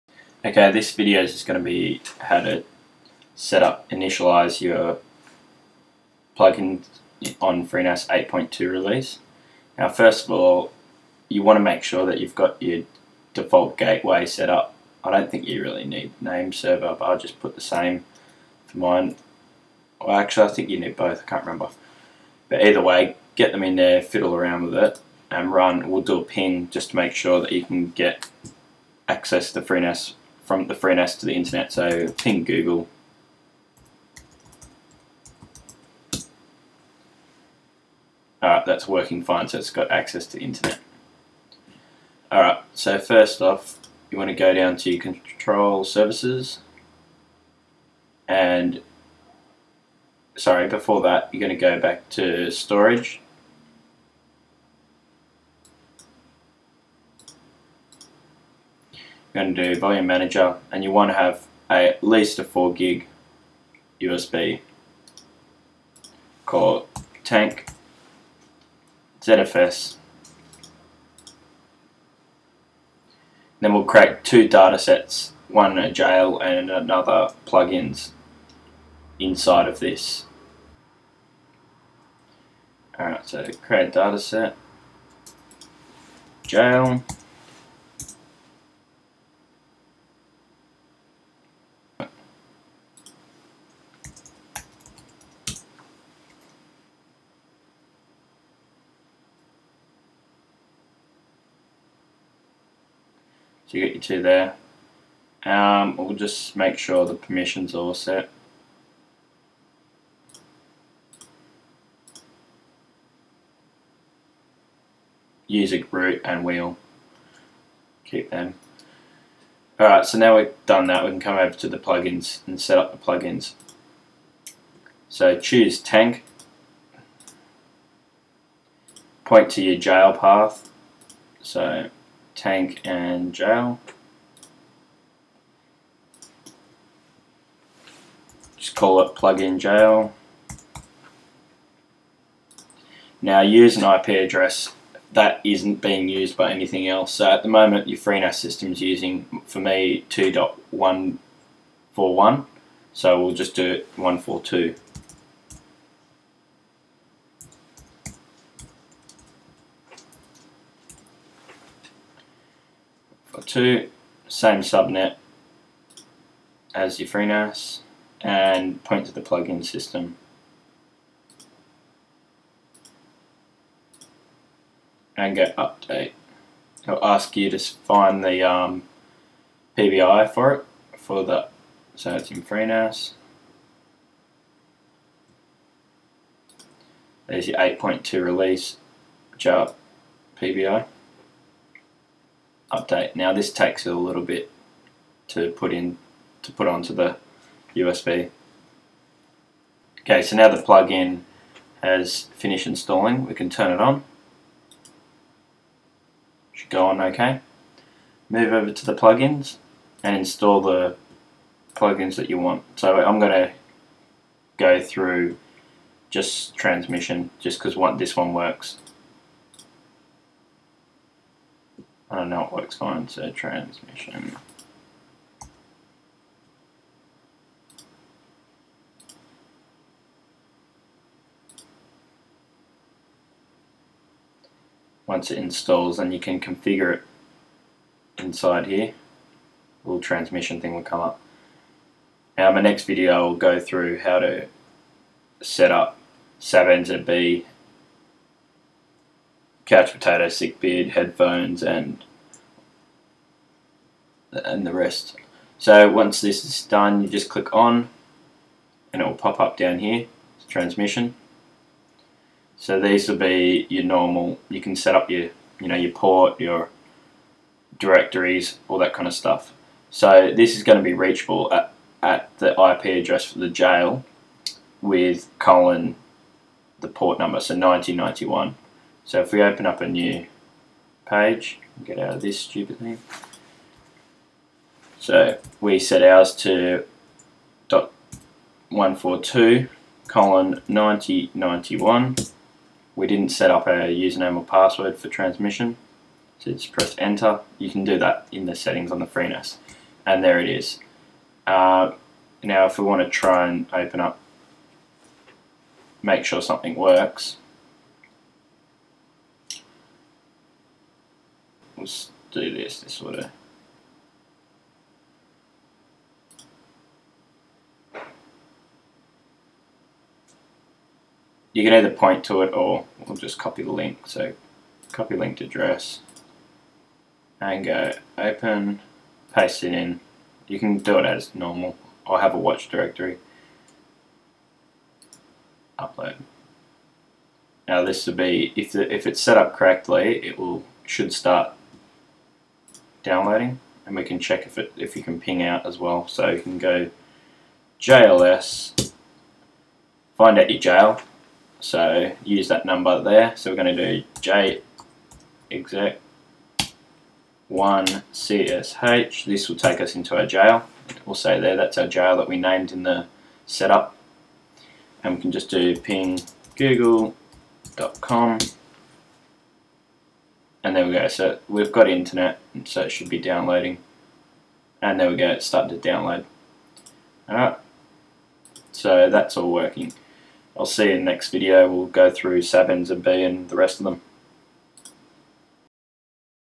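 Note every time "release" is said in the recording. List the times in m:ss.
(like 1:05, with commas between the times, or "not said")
0:08, 3:08.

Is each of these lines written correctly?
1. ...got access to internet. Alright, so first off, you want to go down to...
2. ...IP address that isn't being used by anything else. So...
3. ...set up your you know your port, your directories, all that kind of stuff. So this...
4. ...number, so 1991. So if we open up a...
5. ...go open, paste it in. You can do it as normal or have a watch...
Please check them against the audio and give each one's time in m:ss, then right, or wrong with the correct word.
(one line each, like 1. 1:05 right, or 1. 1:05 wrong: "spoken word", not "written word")
1. 0:39 right
2. 2:23 right
3. 4:24 right
4. 4:37 right
5. 5:27 right.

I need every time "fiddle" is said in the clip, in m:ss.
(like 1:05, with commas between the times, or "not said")
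0:24.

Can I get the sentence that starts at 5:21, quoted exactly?
You can either point to it or we'll just copy the link.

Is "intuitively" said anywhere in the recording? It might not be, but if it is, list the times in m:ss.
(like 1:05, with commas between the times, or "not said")
not said.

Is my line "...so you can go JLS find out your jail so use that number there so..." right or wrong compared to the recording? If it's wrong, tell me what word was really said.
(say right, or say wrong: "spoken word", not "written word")
right.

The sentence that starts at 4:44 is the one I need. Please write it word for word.
So we set ours to dot 142 colon 9091.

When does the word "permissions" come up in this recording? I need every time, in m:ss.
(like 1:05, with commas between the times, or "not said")
1:47.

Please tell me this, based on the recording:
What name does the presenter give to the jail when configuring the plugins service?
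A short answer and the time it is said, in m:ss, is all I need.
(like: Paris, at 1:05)
plug-in jail, at 2:19.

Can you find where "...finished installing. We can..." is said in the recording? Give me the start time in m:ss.
3:22.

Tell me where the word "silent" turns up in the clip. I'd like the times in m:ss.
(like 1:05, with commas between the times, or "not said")
not said.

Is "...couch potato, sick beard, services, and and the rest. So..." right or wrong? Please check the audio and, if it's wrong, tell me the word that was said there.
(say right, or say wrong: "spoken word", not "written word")
wrong: "headphones", not "services".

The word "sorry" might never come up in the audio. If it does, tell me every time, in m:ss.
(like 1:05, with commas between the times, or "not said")
0:50.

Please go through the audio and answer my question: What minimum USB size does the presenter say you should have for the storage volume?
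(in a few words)
4 gig.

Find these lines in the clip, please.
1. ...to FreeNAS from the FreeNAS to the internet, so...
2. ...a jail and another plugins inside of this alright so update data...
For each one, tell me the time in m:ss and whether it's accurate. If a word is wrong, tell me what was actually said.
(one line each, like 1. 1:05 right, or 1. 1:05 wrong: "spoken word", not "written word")
1. 0:29 right
2. 1:15 wrong: "create", not "update".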